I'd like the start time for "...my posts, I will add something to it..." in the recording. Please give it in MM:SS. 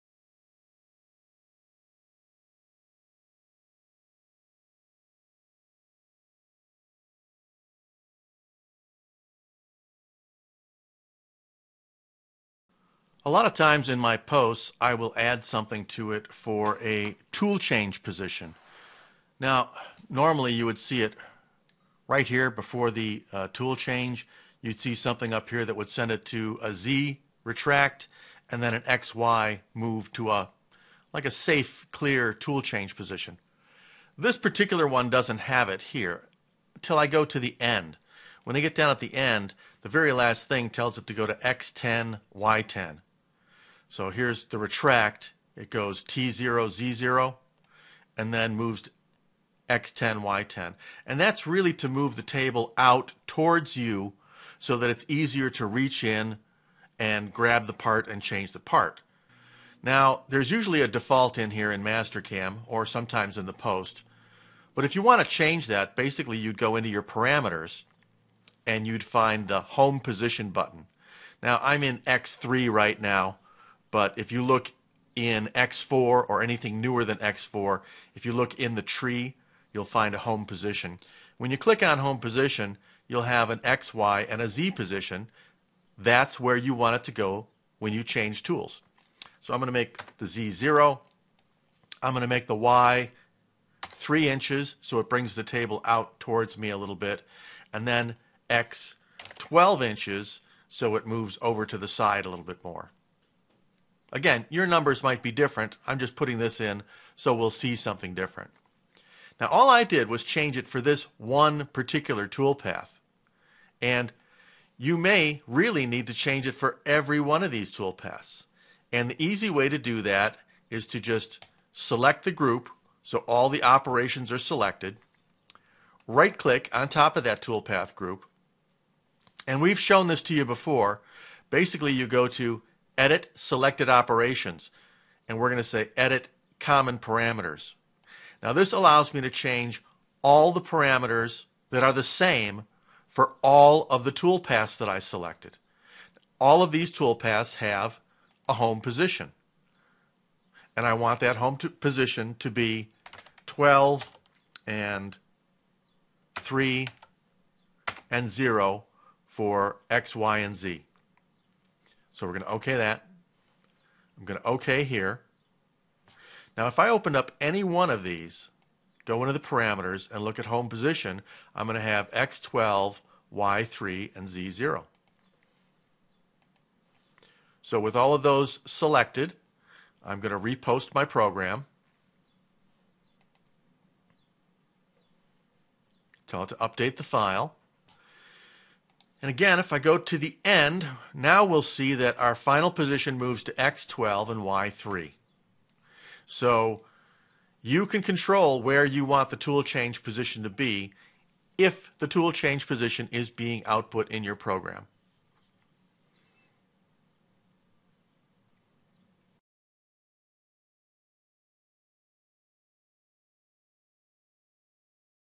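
00:13.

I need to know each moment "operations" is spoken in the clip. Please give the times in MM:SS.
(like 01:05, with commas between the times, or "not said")
02:03, 02:13.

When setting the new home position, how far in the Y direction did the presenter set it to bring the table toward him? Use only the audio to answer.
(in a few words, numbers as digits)
3 inches.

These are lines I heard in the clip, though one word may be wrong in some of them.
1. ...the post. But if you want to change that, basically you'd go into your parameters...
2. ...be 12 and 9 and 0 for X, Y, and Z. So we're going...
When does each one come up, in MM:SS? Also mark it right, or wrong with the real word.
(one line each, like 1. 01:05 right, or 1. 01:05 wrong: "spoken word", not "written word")
1. 01:03 right
2. 02:32 wrong: "3", not "9".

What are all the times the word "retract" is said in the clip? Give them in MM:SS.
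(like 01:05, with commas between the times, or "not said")
00:27, 00:44.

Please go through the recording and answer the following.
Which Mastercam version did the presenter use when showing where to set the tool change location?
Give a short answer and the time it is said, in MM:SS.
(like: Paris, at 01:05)
X3, at 01:12.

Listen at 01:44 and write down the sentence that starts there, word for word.
Again, your numbers might be different.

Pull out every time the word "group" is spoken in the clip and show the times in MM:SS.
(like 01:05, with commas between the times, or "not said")
02:02, 02:07.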